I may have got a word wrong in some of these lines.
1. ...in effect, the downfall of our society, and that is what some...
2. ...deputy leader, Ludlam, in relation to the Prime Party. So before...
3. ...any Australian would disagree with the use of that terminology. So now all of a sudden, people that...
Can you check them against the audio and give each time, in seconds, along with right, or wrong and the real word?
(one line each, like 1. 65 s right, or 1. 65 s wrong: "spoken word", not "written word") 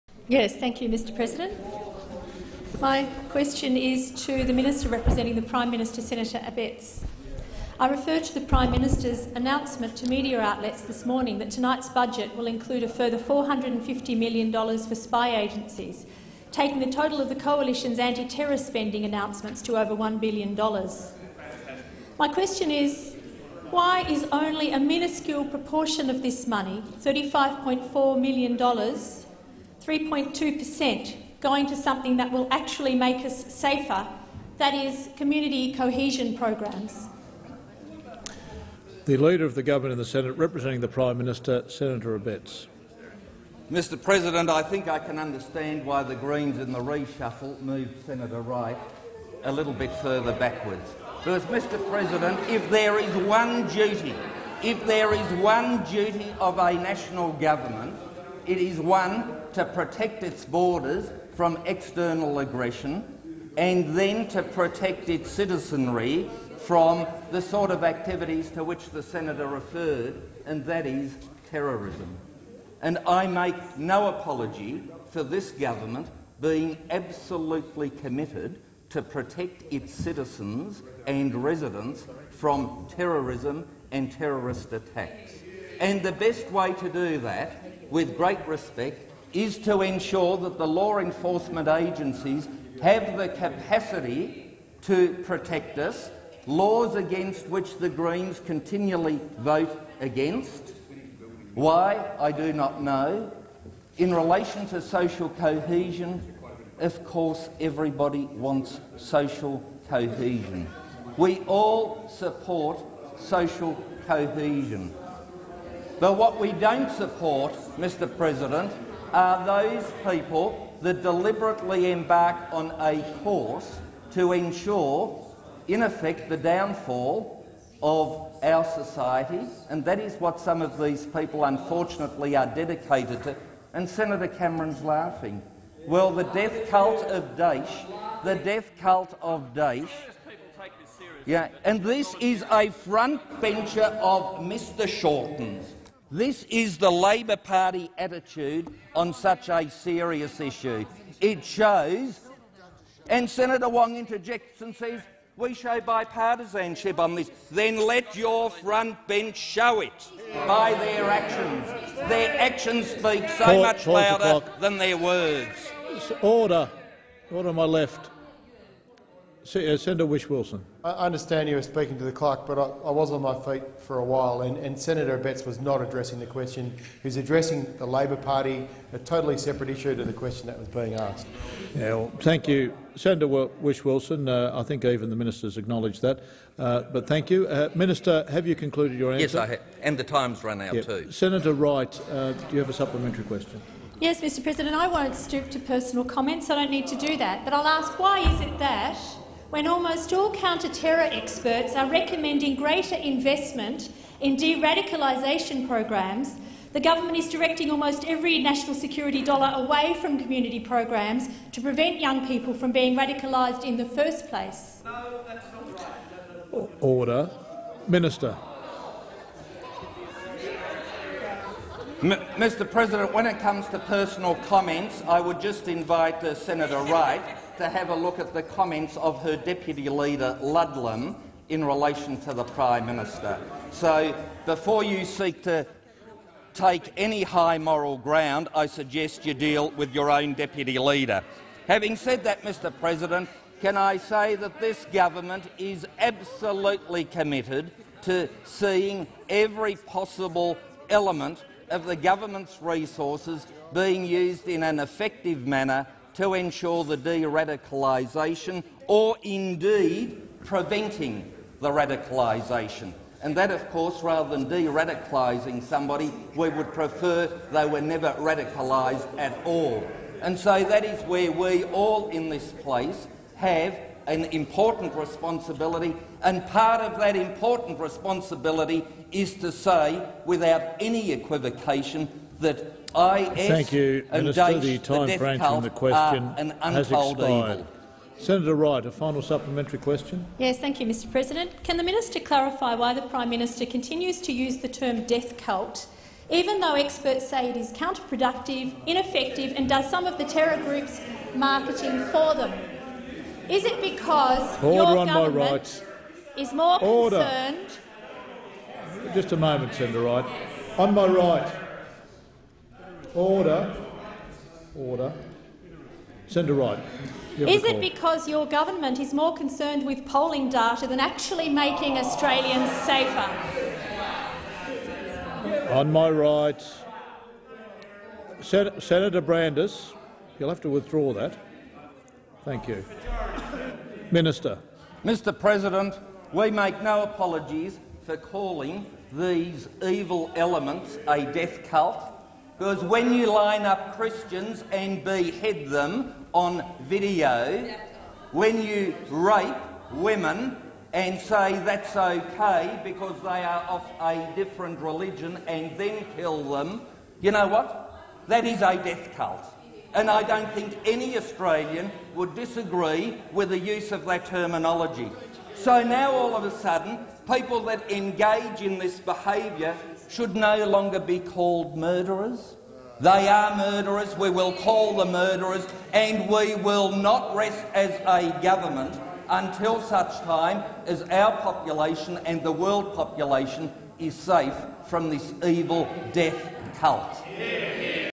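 1. 125 s right
2. 229 s wrong: "Minister", not "Party"
3. 360 s right.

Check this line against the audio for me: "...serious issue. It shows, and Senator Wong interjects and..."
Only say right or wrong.
right.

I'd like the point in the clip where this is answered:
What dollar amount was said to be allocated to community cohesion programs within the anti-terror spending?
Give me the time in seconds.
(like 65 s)
27 s.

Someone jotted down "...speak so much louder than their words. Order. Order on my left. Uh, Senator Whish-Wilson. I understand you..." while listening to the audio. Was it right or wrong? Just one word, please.
right.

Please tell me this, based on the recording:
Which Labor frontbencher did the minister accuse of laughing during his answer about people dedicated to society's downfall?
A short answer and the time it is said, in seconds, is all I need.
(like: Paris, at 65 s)
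Senator Cameron, at 133 s.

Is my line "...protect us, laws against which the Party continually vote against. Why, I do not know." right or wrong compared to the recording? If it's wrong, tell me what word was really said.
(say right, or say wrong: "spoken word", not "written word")
wrong: "Greens", not "Party".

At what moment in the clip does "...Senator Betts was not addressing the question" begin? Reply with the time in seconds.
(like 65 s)
174 s.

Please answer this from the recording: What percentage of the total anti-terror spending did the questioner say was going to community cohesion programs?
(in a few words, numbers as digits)
3.2%.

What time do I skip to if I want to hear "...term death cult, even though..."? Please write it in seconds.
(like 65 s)
294 s.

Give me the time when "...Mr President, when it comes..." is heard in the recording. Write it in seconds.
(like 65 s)
222 s.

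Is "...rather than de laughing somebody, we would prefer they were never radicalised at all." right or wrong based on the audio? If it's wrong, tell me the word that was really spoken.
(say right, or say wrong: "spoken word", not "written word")
wrong: "radicalising", not "laughing".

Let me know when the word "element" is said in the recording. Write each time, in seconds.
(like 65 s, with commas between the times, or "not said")
250 s, 340 s.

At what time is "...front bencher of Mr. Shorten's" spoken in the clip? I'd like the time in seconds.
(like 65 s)
142 s.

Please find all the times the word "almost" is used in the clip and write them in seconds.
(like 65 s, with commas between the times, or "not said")
199 s, 207 s.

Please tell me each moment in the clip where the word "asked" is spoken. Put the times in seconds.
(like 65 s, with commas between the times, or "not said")
180 s.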